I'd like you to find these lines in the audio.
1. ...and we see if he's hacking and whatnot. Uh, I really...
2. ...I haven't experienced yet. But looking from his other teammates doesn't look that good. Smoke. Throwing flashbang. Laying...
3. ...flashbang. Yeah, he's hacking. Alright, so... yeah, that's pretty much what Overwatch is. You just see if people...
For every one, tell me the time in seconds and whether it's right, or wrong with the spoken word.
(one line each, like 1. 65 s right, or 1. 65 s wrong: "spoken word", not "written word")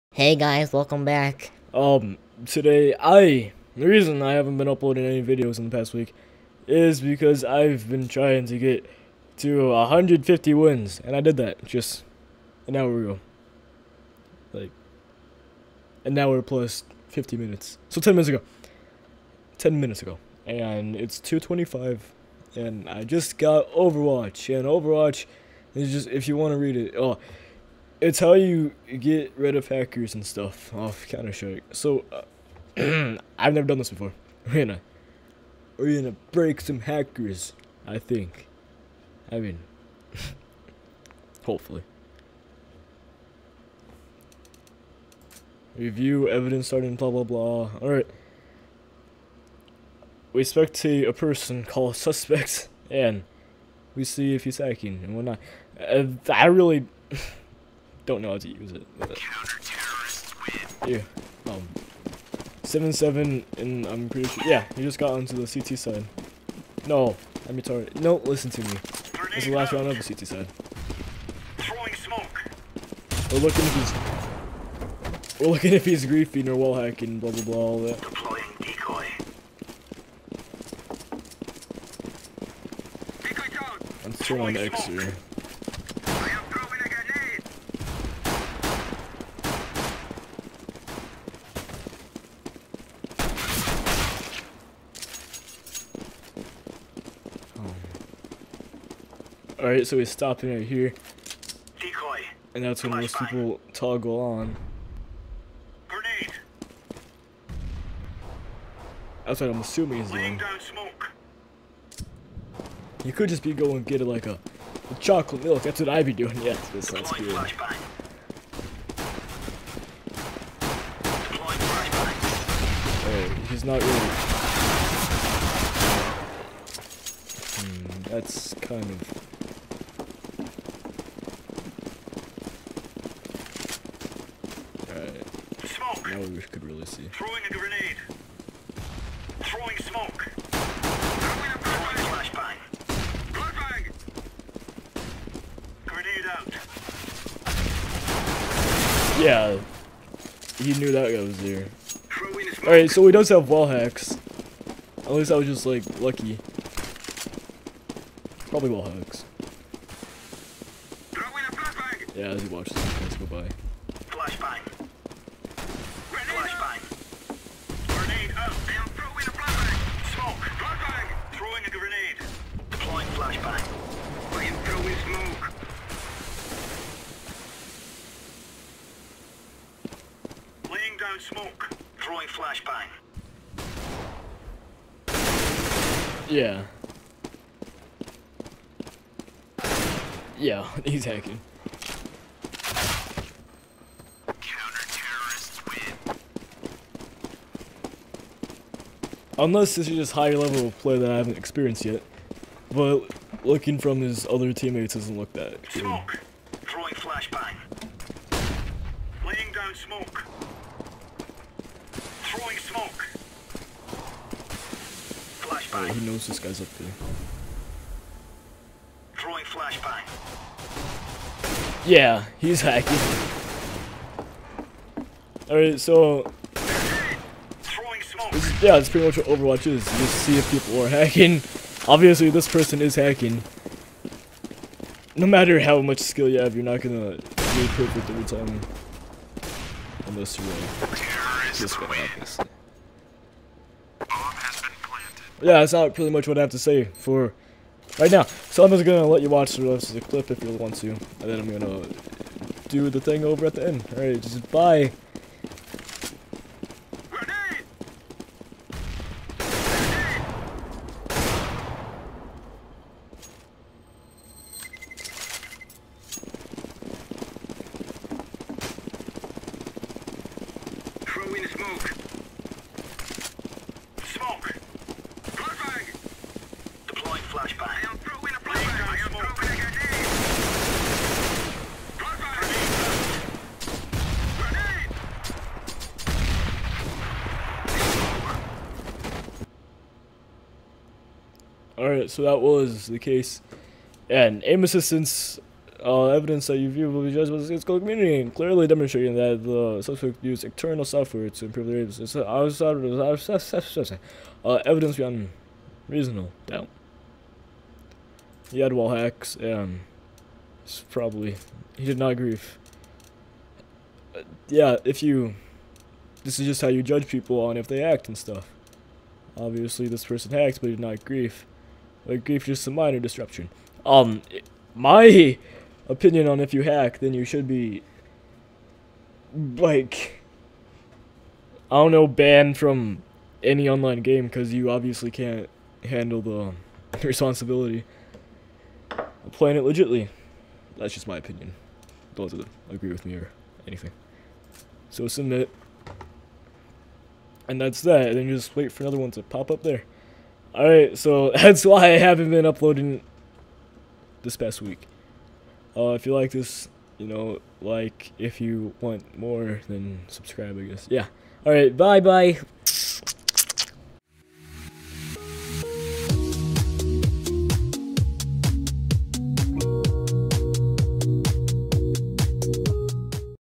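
1. 52 s right
2. 201 s right
3. 219 s right.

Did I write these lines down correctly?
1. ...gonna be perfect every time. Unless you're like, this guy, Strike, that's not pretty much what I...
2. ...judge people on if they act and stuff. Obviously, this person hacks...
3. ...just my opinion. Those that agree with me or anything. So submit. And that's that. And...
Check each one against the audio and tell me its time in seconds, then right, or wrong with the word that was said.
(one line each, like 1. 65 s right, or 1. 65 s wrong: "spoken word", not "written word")
1. 236 s wrong: "Yeah", not "Strike"
2. 316 s right
3. 340 s right.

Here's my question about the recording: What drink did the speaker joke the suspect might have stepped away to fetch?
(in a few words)
Chocolate milk.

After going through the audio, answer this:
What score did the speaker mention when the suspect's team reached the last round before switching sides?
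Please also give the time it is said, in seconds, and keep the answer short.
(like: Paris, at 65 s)
7-7, at 62 s.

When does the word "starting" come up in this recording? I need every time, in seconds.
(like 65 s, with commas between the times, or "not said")
46 s.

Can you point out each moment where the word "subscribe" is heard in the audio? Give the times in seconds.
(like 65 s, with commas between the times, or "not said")
360 s.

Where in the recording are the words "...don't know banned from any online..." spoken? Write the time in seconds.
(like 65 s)
331 s.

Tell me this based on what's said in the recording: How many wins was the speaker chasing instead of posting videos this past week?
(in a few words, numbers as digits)
150.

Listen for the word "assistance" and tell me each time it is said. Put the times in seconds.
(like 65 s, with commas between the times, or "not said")
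294 s.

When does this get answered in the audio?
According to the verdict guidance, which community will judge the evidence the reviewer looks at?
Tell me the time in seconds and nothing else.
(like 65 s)
297 s.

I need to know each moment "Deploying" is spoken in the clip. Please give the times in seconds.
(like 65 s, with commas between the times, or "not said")
78 s, 276 s.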